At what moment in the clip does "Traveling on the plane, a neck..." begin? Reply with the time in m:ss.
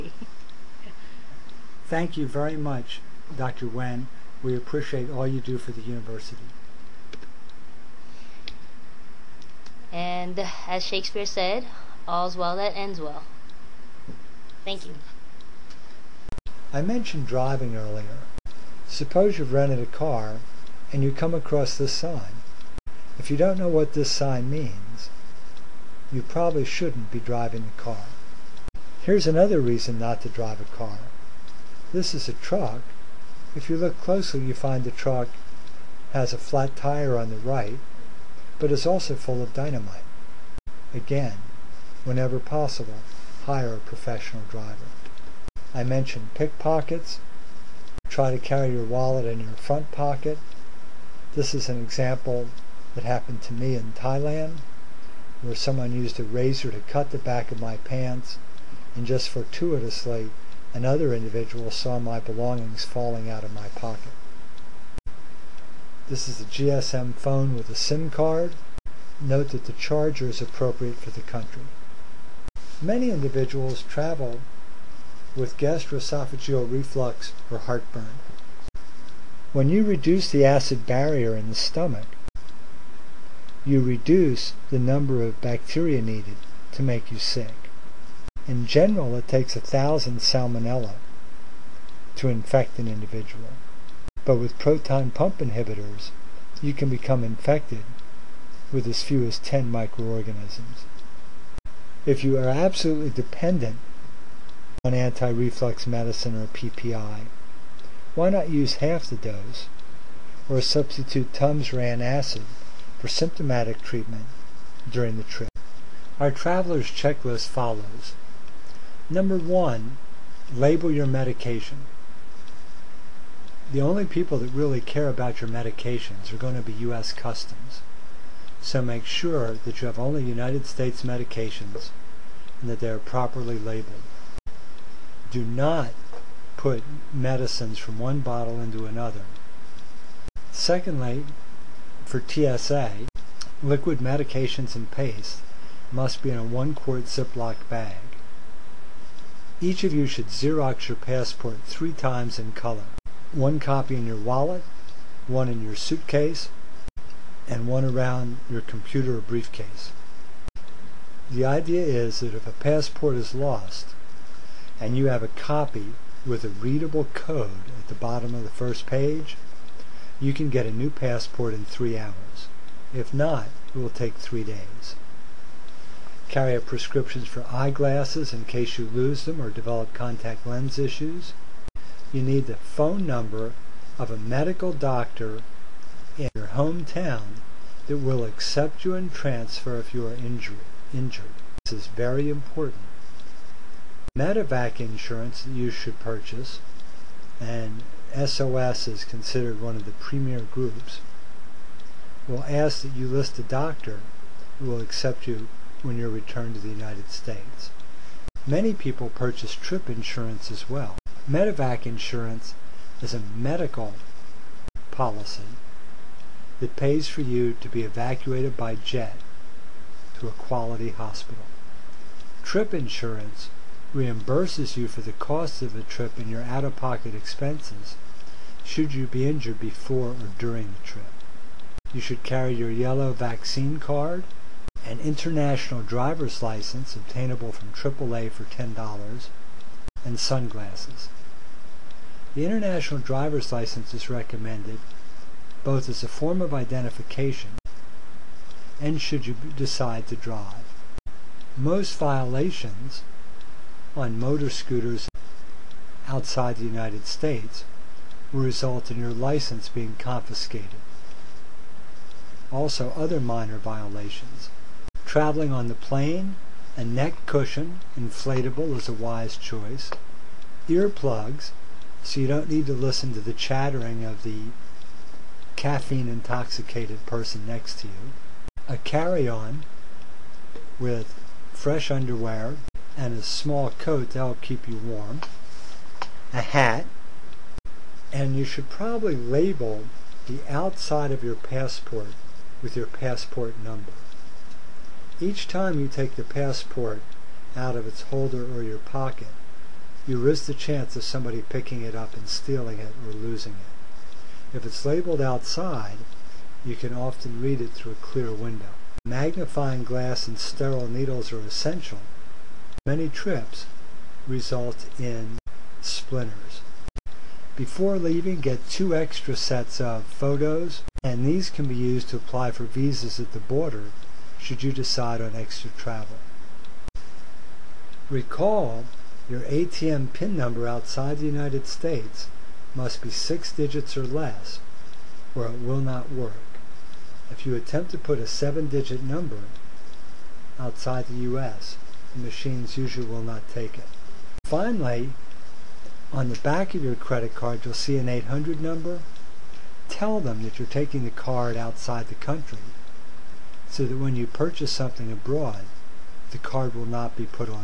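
4:25.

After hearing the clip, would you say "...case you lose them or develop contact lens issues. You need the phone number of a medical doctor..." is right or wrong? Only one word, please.
right.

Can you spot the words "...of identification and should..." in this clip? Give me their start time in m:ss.
4:06.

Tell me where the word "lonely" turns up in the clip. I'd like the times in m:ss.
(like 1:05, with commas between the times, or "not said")
not said.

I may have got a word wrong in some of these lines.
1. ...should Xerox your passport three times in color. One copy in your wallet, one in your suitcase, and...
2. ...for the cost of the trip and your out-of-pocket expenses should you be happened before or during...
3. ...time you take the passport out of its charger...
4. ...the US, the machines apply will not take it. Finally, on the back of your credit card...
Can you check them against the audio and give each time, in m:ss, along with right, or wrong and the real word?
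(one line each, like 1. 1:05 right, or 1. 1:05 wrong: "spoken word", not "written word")
1. 2:30 right
2. 3:44 wrong: "injured", not "happened"
3. 4:55 wrong: "holder", not "charger"
4. 5:41 wrong: "usually", not "apply".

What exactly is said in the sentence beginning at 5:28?
Recall your ATM PIN number outside the United States must be six digits or less, or it will not work.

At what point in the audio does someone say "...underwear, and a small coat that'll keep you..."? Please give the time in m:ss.
4:41.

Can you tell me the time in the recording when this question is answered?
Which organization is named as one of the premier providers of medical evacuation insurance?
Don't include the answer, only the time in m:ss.
3:18.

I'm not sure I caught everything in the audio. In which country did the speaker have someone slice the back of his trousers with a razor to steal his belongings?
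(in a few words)
Thailand.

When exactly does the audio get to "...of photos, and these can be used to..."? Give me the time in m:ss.
5:19.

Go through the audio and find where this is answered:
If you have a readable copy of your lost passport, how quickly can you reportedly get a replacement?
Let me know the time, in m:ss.
2:51.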